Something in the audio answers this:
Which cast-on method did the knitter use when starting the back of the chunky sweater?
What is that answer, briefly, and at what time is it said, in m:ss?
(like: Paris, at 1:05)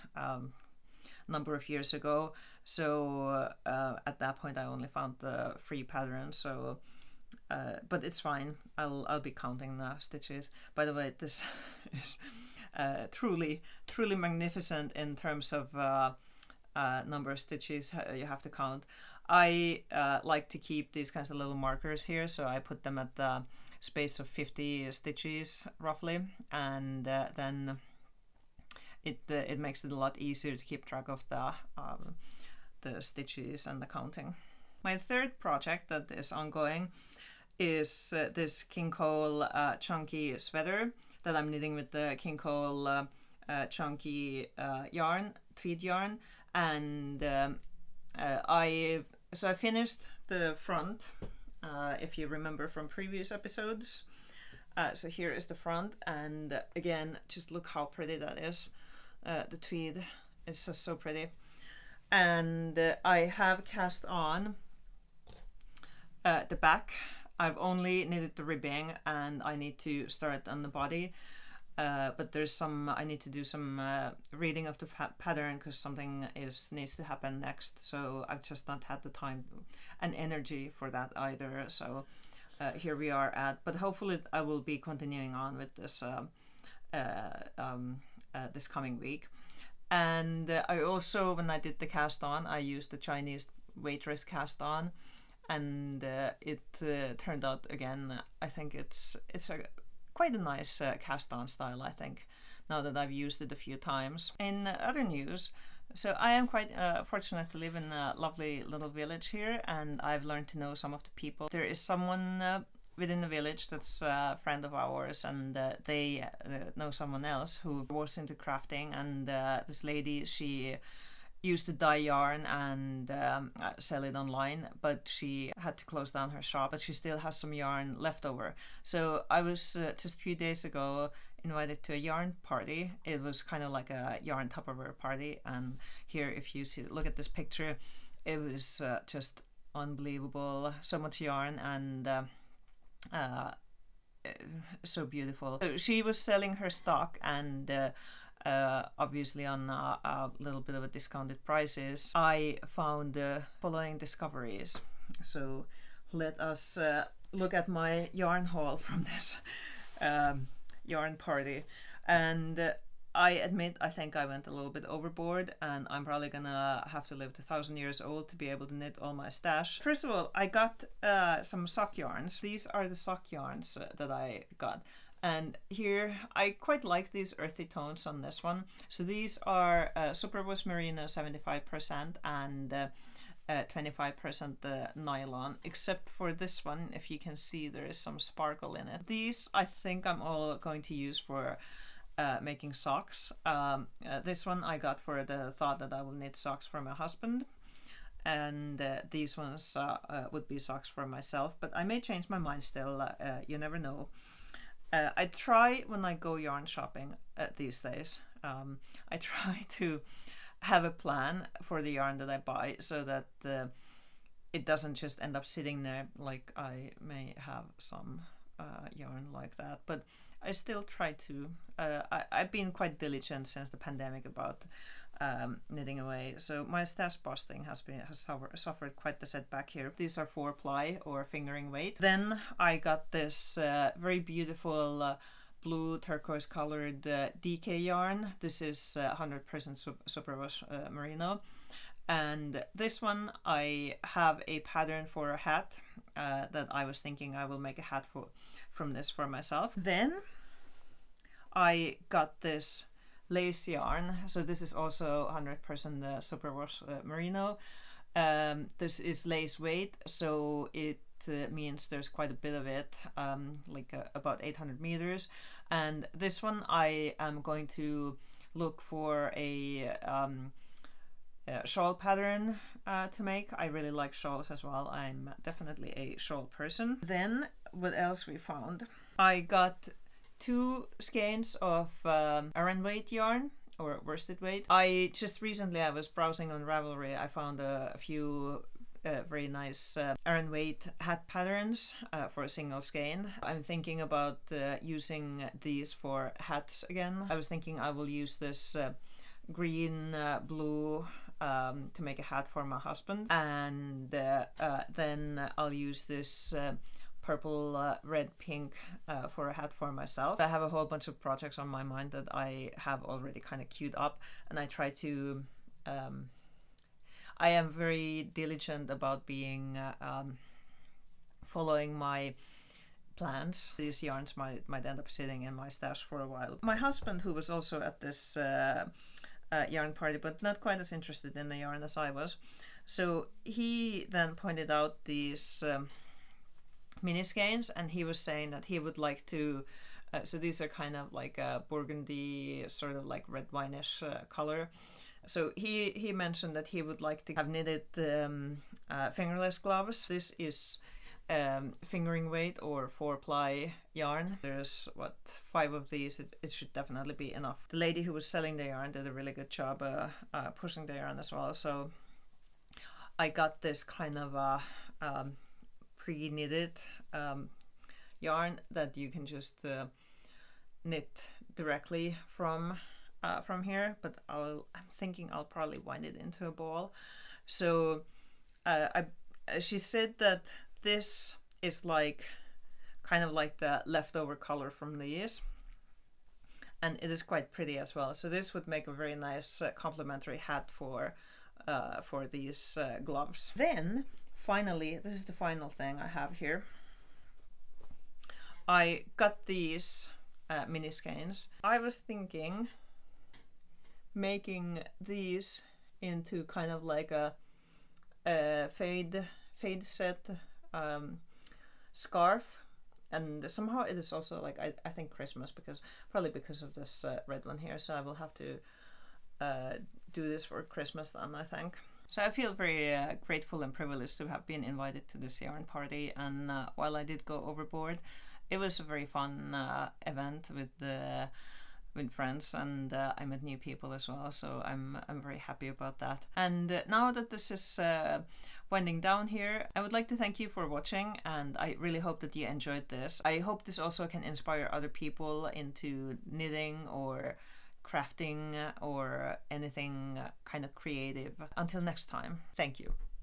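Chinese waitress cast on, at 1:32.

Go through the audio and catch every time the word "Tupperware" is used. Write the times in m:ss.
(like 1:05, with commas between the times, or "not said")
2:14.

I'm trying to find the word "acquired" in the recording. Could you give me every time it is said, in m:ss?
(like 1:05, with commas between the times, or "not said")
not said.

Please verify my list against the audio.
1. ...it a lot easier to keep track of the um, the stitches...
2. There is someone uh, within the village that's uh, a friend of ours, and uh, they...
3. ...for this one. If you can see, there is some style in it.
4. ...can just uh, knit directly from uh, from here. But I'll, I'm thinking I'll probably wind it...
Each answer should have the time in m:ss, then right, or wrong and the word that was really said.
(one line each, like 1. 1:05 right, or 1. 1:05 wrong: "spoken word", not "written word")
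1. 0:29 right
2. 1:51 right
3. 3:06 wrong: "sparkle", not "style"
4. 6:09 right.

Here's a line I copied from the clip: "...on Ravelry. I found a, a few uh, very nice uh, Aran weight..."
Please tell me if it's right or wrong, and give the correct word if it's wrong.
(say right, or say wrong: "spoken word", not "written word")
right.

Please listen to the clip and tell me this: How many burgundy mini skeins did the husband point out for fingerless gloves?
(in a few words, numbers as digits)
5.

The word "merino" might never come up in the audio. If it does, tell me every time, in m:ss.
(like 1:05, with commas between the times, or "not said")
3:00, 4:00, 4:17.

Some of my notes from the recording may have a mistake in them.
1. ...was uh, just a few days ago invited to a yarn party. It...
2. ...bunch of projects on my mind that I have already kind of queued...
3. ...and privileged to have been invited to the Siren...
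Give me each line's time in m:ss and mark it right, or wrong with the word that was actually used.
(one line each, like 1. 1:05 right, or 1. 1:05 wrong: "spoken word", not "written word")
1. 2:09 right
2. 5:10 right
3. 7:03 right.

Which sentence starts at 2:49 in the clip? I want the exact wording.
First of all, I got uh, some sock yarns.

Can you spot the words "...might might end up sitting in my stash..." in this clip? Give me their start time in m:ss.
5:24.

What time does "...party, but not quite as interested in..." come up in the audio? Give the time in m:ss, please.
5:29.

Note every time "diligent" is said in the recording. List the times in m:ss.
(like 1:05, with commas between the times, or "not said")
3:42, 5:18.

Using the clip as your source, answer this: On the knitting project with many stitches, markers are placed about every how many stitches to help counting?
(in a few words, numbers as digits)
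50.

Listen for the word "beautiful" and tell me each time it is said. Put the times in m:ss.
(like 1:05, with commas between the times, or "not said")
2:25, 3:54.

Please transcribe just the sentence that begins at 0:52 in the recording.
if you remember from previous episodes, so here is the front, and again, just look how pretty that is.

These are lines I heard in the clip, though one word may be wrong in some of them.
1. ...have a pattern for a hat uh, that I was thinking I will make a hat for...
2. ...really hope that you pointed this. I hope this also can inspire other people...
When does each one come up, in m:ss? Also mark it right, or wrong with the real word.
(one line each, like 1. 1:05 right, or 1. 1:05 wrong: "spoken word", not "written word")
1. 4:04 right
2. 7:21 wrong: "enjoyed", not "pointed".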